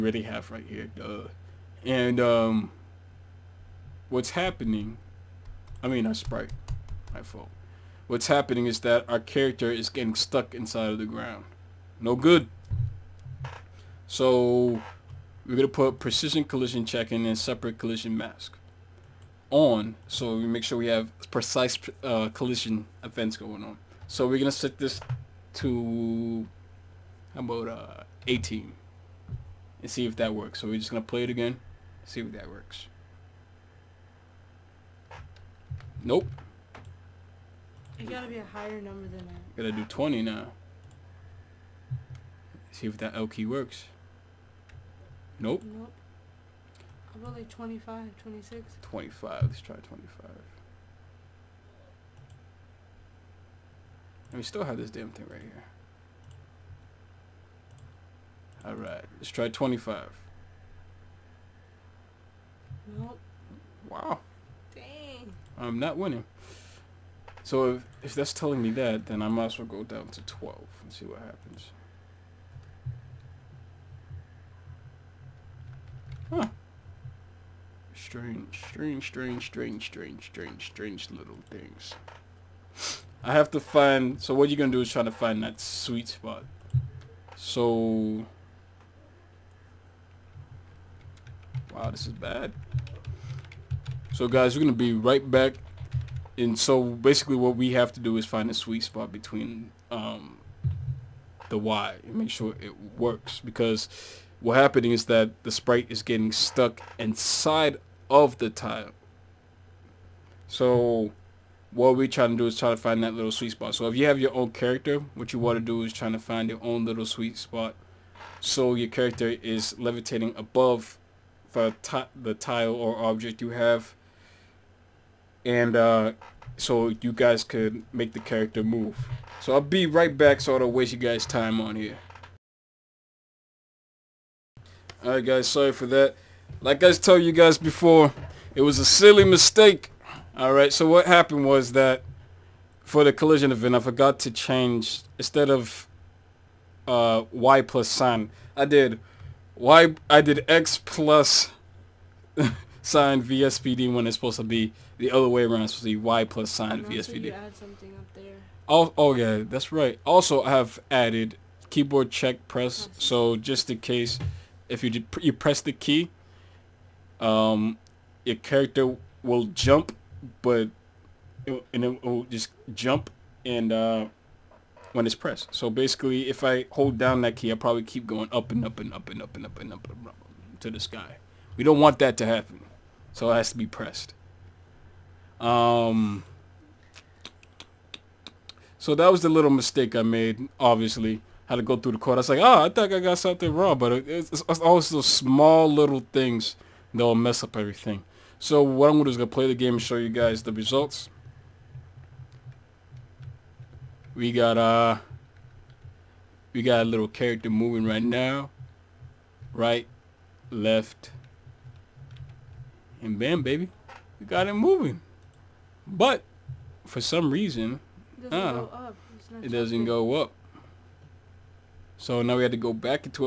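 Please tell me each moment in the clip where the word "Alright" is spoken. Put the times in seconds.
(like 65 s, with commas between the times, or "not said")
58 s, 135 s, 140 s.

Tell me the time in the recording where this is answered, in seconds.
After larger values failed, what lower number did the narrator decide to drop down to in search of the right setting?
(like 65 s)
70 s.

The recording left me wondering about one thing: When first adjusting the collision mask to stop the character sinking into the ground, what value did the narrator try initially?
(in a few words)
18.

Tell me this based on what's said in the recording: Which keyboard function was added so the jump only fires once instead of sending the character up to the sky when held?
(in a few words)
keyboard check press.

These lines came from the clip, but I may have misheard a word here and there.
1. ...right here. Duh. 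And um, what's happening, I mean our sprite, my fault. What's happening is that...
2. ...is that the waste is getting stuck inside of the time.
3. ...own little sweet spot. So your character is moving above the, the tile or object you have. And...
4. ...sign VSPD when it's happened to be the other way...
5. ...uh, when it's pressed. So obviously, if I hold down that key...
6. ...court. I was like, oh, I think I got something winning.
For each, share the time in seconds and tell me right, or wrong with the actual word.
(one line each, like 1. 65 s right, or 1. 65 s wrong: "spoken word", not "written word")
1. 0 s right
2. 104 s wrong: "sprite", not "waste"
3. 116 s wrong: "levitating", not "moving"
4. 152 s wrong: "supposed", not "happened"
5. 173 s wrong: "basically", not "obviously"
6. 191 s wrong: "wrong", not "winning".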